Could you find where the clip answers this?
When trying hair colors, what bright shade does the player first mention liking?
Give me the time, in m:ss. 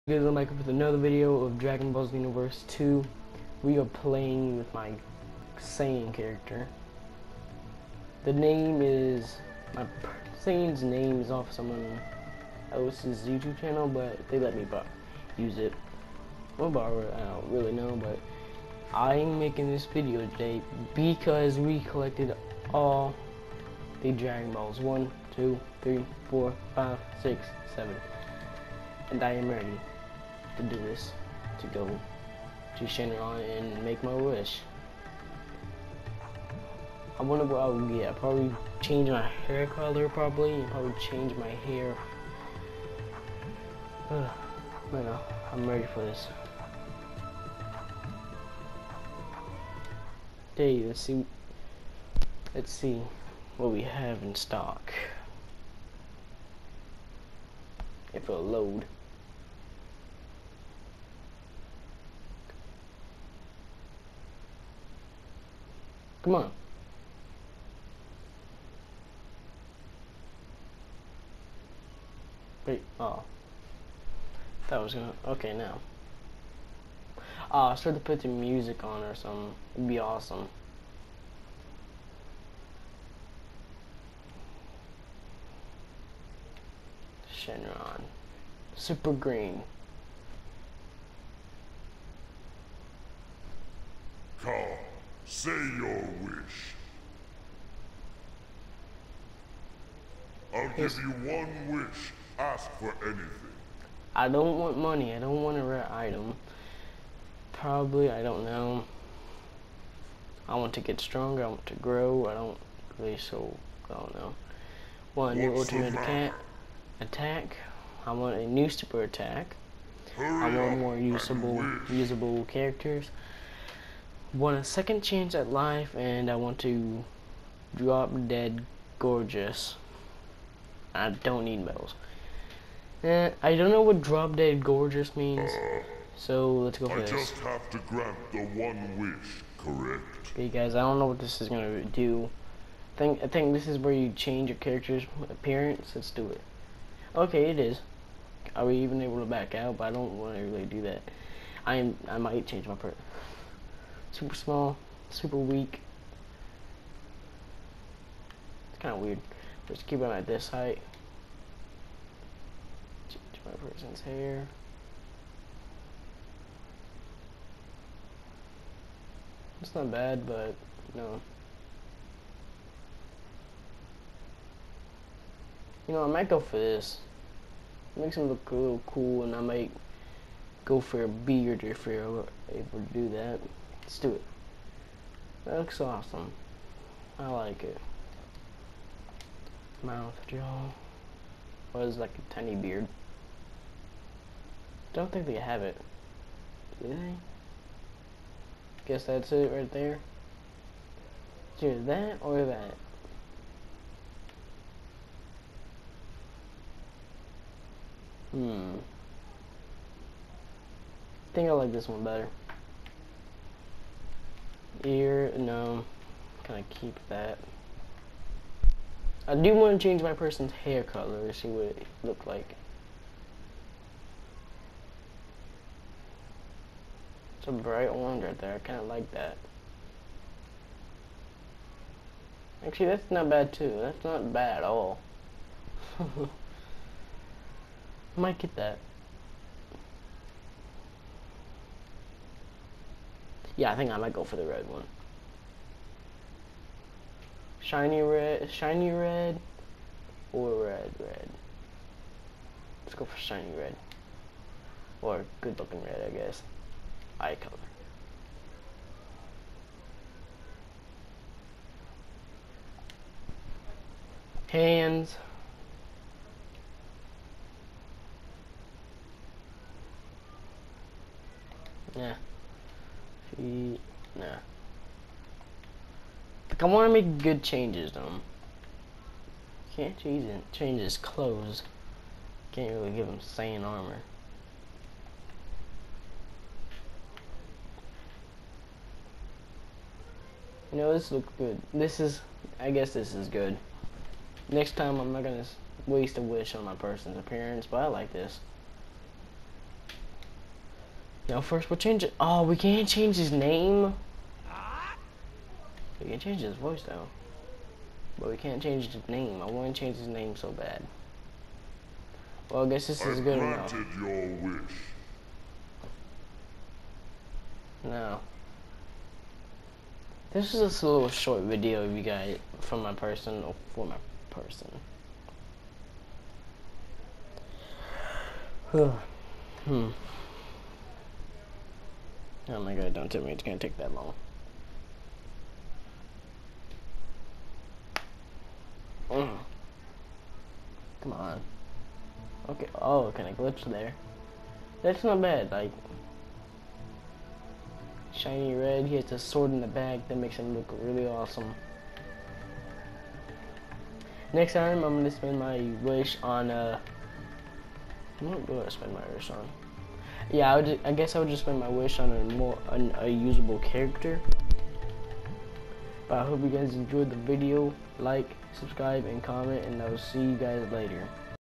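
3:47.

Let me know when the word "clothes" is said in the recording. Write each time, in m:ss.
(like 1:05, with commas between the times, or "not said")
4:40.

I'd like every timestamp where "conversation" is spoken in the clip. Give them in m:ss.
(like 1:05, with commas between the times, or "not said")
not said.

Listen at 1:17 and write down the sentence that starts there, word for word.
Oh, I should to put the music on or something.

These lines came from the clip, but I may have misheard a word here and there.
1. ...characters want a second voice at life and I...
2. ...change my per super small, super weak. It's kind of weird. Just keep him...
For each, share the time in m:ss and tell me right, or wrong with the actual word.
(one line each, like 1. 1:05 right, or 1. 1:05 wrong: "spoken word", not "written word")
1. 2:02 wrong: "chance", not "voice"
2. 2:32 right.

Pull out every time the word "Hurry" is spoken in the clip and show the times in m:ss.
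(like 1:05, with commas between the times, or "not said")
2:00.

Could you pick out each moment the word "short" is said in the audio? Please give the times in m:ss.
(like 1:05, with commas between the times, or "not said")
5:21.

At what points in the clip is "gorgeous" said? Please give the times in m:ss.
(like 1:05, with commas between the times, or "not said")
2:08, 2:14.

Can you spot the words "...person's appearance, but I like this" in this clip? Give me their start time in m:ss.
4:56.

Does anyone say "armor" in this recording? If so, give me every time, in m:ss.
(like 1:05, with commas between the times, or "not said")
4:43.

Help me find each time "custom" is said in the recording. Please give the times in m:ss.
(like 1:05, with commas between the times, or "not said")
not said.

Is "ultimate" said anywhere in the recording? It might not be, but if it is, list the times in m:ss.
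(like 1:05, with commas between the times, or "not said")
1:55.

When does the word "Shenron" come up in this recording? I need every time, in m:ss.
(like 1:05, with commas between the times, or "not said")
0:32, 1:27.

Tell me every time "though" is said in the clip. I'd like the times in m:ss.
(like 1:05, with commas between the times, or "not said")
4:37, 5:06.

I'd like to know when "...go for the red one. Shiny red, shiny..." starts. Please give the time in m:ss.
4:04.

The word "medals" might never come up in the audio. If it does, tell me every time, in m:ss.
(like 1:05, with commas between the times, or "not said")
2:11.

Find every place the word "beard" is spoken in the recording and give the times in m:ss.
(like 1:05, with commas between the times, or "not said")
3:01, 3:12.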